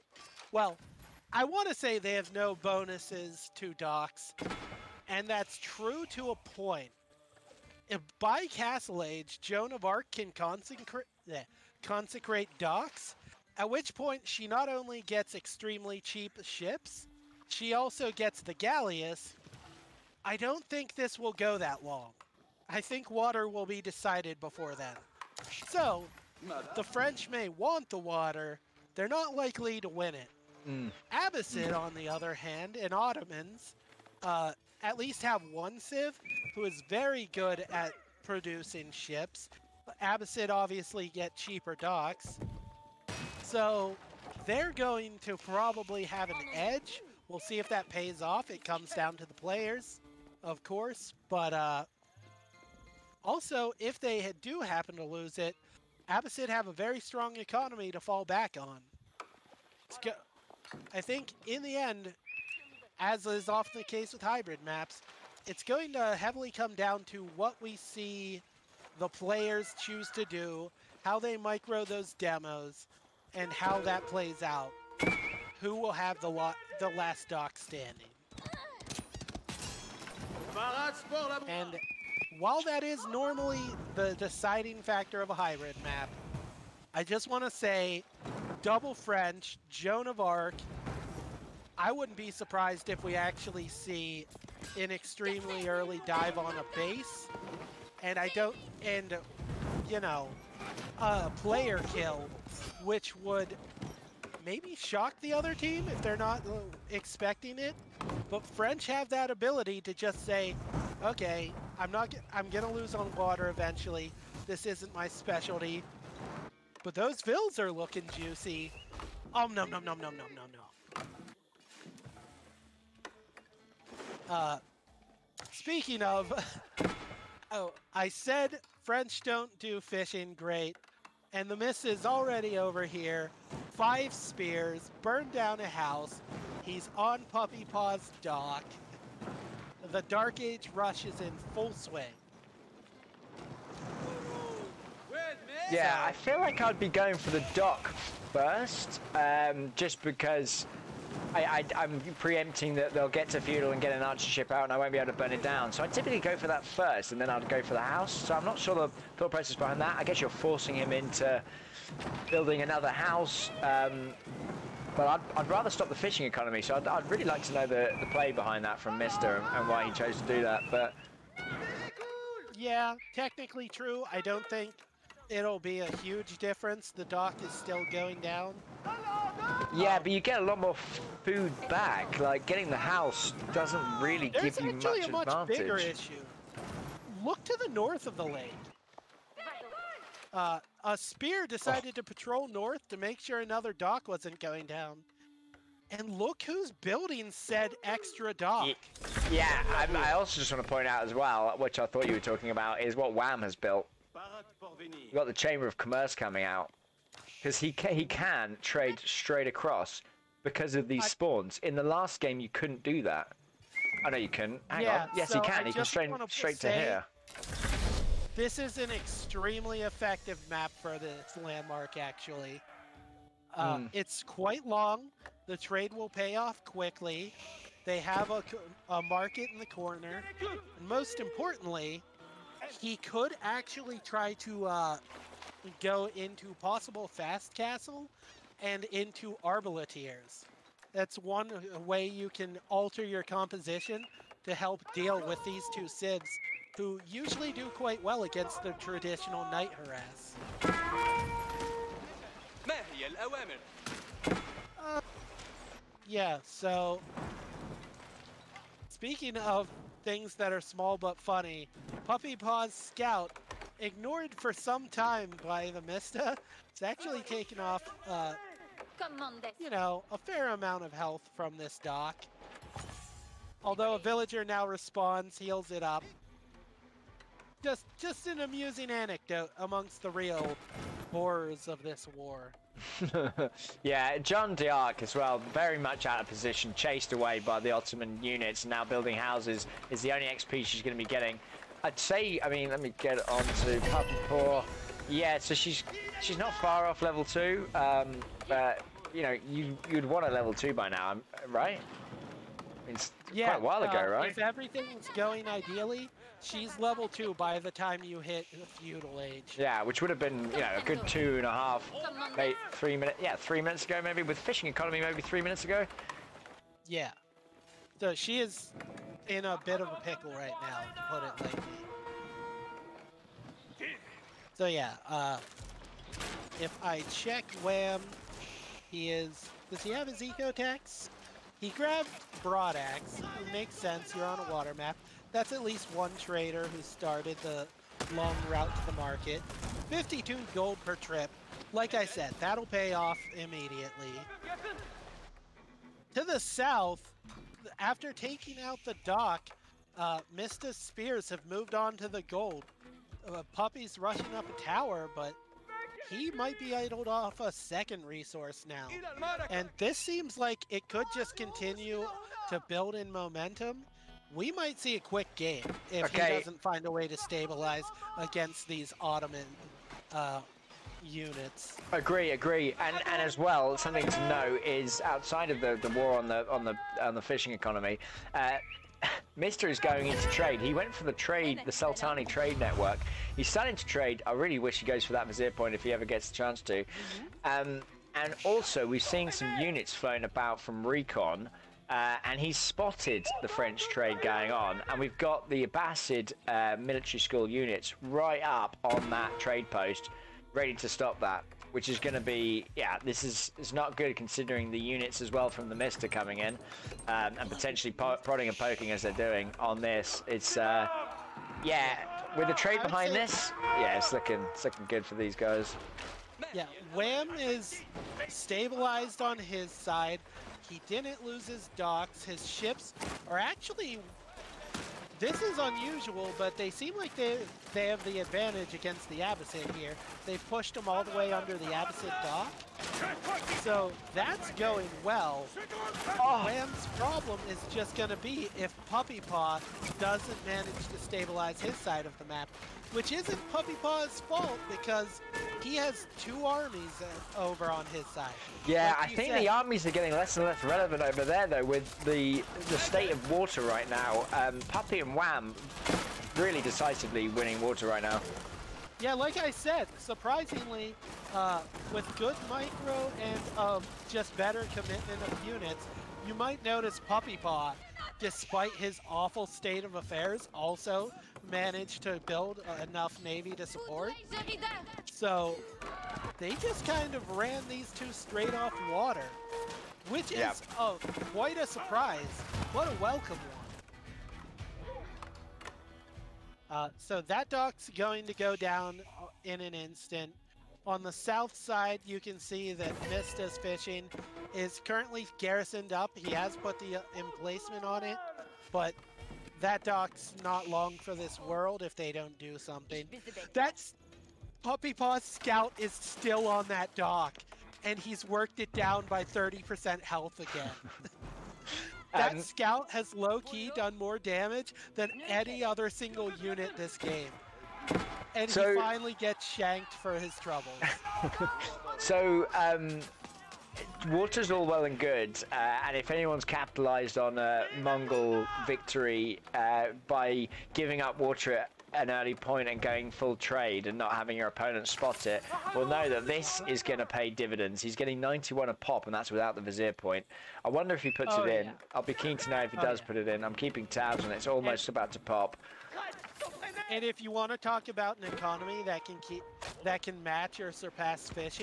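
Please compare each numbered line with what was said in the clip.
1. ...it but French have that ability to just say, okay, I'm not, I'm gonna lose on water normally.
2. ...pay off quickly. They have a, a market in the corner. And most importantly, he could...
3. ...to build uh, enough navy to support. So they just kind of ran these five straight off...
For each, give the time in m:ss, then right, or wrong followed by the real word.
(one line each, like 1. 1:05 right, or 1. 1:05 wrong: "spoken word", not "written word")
1. 1:47 wrong: "eventually", not "normally"
2. 3:46 right
3. 7:52 wrong: "two", not "five".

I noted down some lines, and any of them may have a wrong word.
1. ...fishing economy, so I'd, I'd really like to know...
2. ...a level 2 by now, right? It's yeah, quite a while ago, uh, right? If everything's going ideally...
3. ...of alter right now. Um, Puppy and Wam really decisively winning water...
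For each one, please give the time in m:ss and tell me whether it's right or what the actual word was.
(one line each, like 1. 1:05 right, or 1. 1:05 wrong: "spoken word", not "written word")
1. 2:45 right
2. 5:00 right
3. 7:33 wrong: "water", not "alter".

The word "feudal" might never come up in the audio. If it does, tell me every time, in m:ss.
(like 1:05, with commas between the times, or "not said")
2:33, 5:08.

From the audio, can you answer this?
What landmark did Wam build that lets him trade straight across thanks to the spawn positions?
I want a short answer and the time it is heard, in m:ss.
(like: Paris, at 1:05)
Chamber of Commerce, at 3:25.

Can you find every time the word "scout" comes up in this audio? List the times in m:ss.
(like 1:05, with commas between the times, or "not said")
4:22, 8:25, 8:32.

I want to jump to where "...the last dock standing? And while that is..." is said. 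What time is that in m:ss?
1:16.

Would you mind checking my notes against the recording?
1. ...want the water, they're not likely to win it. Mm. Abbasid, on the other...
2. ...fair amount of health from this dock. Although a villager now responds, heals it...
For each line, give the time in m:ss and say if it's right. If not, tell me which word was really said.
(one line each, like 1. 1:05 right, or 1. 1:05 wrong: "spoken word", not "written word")
1. 0:27 right
2. 4:30 right.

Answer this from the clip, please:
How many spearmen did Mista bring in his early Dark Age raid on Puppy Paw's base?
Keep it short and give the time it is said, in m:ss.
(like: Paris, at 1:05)
5, at 2:13.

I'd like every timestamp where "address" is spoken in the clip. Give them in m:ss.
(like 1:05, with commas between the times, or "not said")
not said.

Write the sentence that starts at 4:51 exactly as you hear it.
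I'd say, I mean, let me get on to Puppy Paw.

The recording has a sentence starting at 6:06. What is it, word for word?
he doesn't find a way to stabilize against these Ottoman uh, units.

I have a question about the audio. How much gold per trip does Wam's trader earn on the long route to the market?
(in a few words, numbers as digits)
52.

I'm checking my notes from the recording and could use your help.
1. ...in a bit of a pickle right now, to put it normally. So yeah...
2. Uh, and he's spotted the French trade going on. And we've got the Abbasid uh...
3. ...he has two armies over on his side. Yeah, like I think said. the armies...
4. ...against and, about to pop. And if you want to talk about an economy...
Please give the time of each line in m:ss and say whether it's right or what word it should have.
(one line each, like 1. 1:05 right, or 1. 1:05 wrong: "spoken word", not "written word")
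1. 5:19 wrong: "lightly", not "normally"
2. 6:31 right
3. 7:25 right
4. 9:04 wrong: "almost", not "against".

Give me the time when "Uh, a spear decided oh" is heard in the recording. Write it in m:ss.
3:10.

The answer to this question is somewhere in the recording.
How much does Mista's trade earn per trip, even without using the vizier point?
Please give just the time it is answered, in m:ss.
8:58.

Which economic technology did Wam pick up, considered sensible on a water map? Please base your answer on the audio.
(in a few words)
Broadaxe.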